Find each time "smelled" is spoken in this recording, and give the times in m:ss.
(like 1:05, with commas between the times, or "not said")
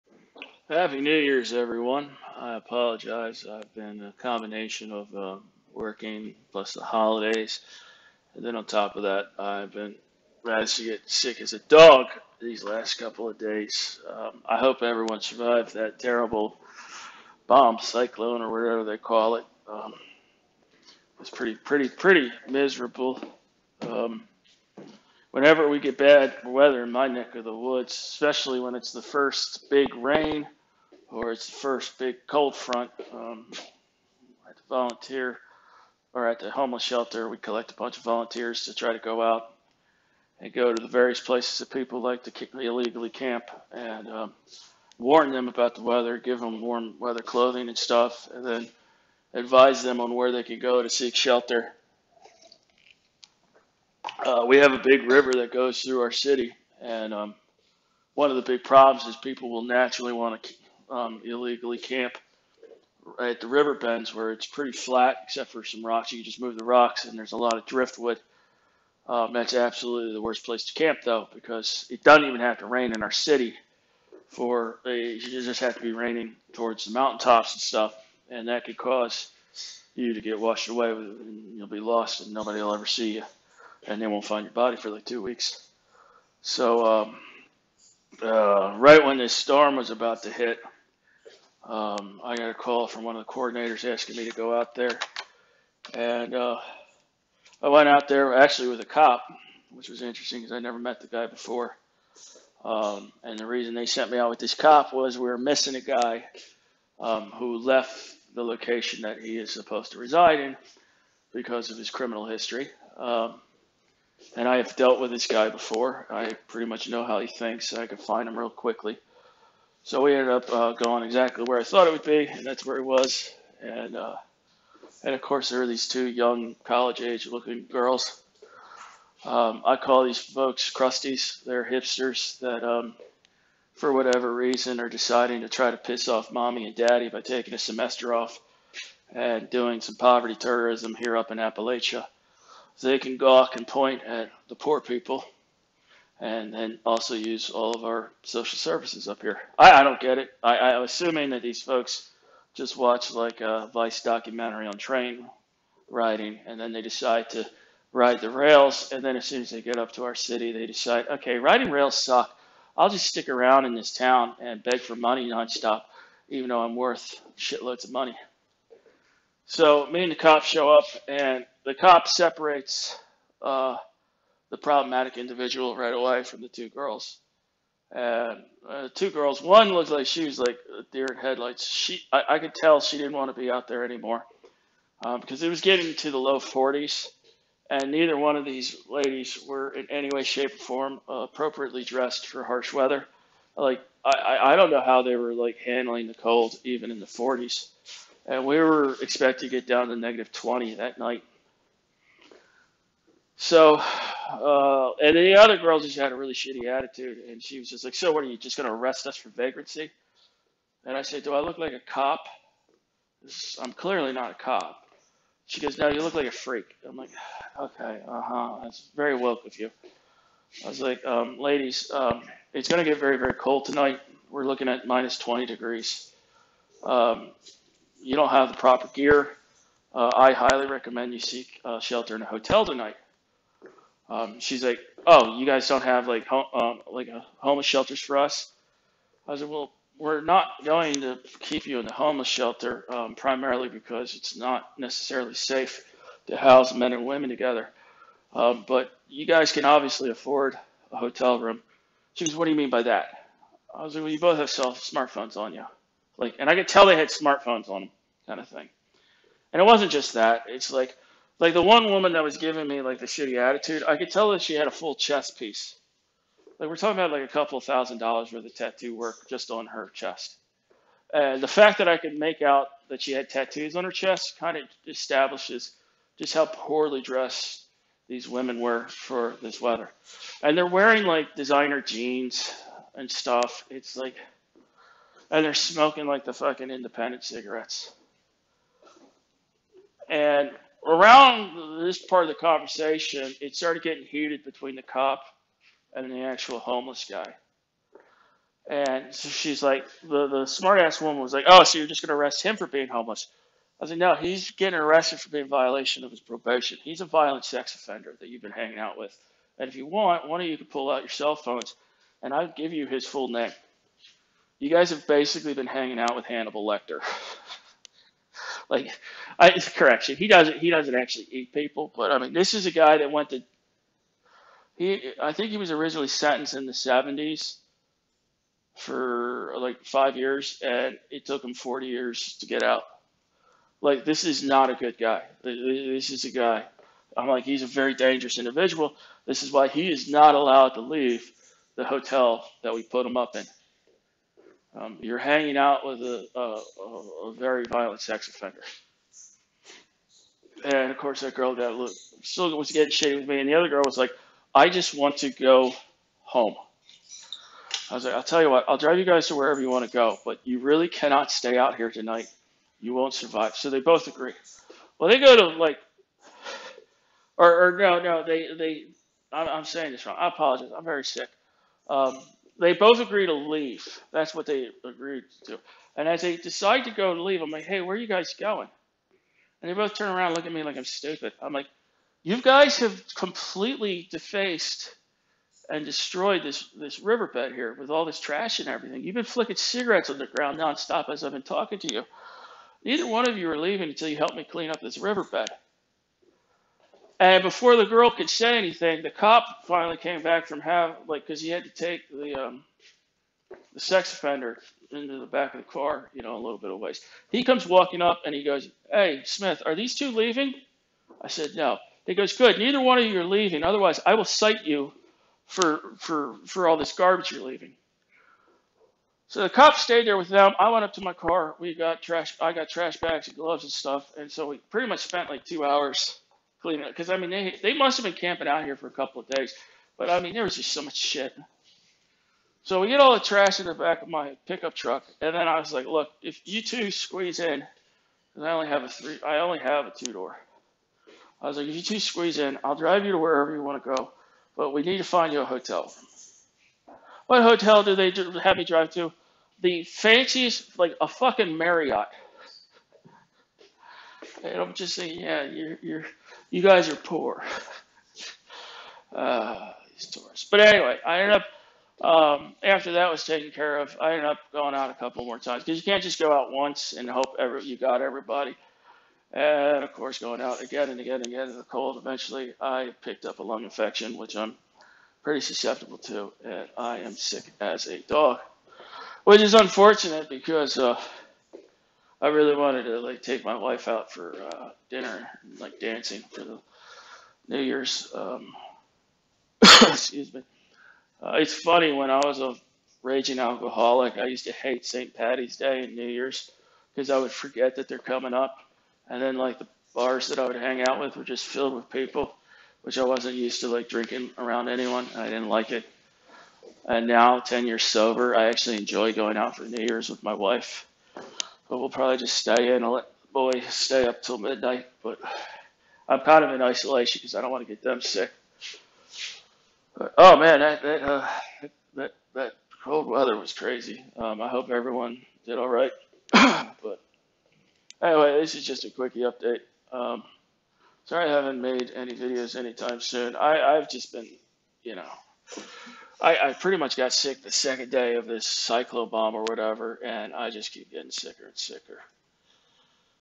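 not said.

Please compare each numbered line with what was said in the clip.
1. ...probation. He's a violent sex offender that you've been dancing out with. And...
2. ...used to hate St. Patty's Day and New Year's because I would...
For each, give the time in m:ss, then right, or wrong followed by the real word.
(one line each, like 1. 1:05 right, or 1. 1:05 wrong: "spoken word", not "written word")
1. 5:06 wrong: "hanging", not "dancing"
2. 8:14 right.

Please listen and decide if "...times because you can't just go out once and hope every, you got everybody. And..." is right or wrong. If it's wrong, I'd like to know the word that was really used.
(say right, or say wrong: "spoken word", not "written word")
right.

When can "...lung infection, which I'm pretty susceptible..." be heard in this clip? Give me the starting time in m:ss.
7:53.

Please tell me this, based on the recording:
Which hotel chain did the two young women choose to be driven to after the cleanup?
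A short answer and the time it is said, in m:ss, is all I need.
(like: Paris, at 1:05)
Marriott, at 7:31.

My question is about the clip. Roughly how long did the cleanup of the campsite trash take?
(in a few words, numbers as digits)
two hours.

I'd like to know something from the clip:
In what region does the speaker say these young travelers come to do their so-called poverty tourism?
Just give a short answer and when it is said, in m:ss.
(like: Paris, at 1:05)
Appalachia, at 2:21.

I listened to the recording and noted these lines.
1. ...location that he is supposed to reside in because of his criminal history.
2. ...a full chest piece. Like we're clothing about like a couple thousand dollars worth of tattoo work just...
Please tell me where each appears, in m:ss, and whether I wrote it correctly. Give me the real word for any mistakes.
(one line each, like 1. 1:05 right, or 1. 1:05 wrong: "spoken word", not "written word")
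1. 1:48 right
2. 4:24 wrong: "talking", not "clothing".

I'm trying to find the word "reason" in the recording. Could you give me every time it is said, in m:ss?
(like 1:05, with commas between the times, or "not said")
1:43, 2:14.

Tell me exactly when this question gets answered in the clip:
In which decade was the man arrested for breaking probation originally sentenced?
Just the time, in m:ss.
5:26.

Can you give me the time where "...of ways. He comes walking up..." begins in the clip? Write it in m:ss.
6:46.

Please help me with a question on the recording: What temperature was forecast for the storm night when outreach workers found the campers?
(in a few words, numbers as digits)
minus 20 degrees.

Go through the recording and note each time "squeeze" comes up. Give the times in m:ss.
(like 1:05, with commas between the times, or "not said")
7:16, 7:21.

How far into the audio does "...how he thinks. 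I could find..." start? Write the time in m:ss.
1:57.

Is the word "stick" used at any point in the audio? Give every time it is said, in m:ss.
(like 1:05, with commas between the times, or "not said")
2:43.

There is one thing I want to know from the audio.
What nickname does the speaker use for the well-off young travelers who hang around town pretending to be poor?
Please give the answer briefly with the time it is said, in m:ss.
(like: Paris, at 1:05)
crusties, at 2:10.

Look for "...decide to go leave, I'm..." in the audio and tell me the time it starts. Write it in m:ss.
6:16.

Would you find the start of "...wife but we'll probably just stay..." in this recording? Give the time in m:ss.
8:30.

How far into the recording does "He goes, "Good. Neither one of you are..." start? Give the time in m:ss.
6:52.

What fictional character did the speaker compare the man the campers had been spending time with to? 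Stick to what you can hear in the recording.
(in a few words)
Hannibal Lecter.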